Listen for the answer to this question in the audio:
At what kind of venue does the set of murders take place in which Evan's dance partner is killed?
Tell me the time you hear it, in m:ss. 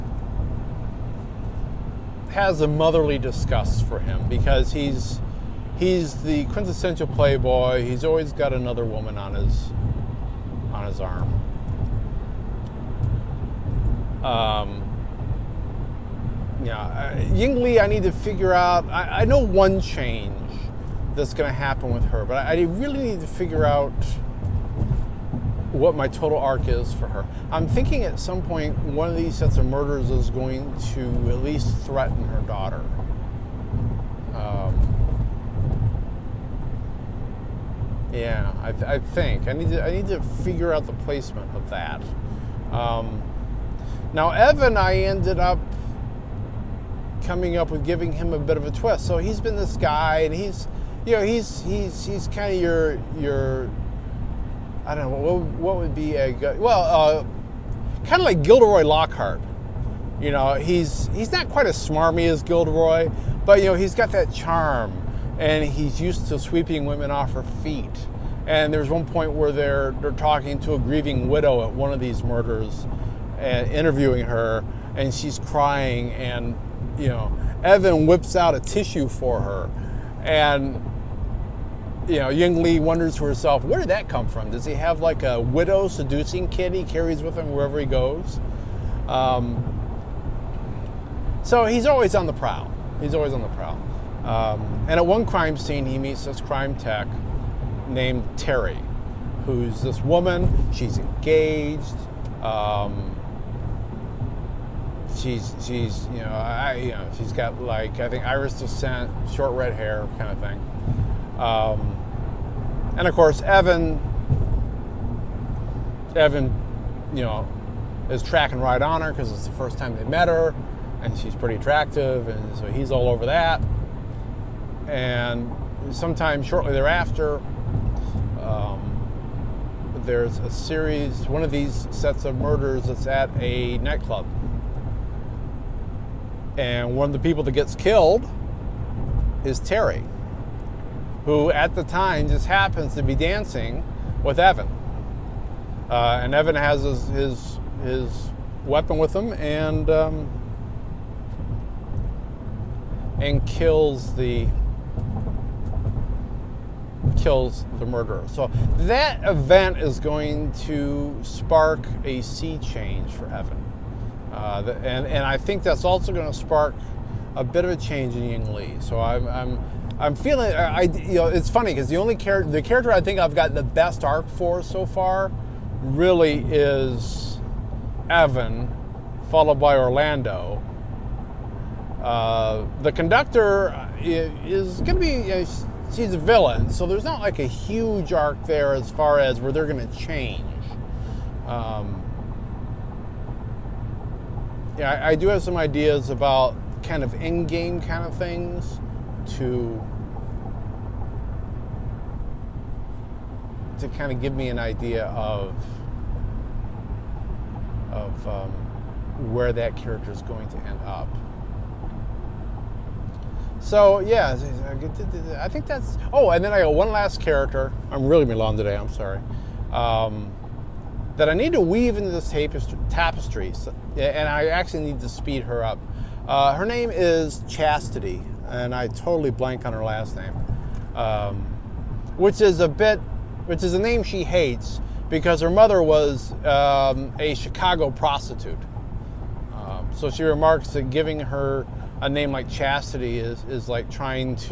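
2:13.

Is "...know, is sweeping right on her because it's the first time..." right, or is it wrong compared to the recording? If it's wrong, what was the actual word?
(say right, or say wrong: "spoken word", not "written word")
wrong: "tracking", not "sweeping".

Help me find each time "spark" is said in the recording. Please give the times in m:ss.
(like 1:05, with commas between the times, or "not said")
2:41, 2:46.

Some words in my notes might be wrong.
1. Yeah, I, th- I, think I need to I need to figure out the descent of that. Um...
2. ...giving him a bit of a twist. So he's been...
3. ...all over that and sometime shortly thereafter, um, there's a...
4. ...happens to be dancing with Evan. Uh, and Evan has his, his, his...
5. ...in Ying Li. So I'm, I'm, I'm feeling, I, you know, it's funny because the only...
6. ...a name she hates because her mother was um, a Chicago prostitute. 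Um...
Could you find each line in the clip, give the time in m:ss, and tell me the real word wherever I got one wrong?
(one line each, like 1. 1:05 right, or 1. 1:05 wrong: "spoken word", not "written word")
1. 0:38 wrong: "placement", not "descent"
2. 0:47 right
3. 2:02 right
4. 2:22 right
5. 2:48 right
6. 3:53 right.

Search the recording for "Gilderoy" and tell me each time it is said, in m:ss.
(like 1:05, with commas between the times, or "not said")
0:58, 1:02.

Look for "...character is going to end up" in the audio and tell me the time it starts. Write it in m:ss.
3:29.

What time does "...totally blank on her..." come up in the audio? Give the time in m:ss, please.
3:48.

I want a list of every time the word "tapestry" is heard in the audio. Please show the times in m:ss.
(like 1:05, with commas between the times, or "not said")
3:42.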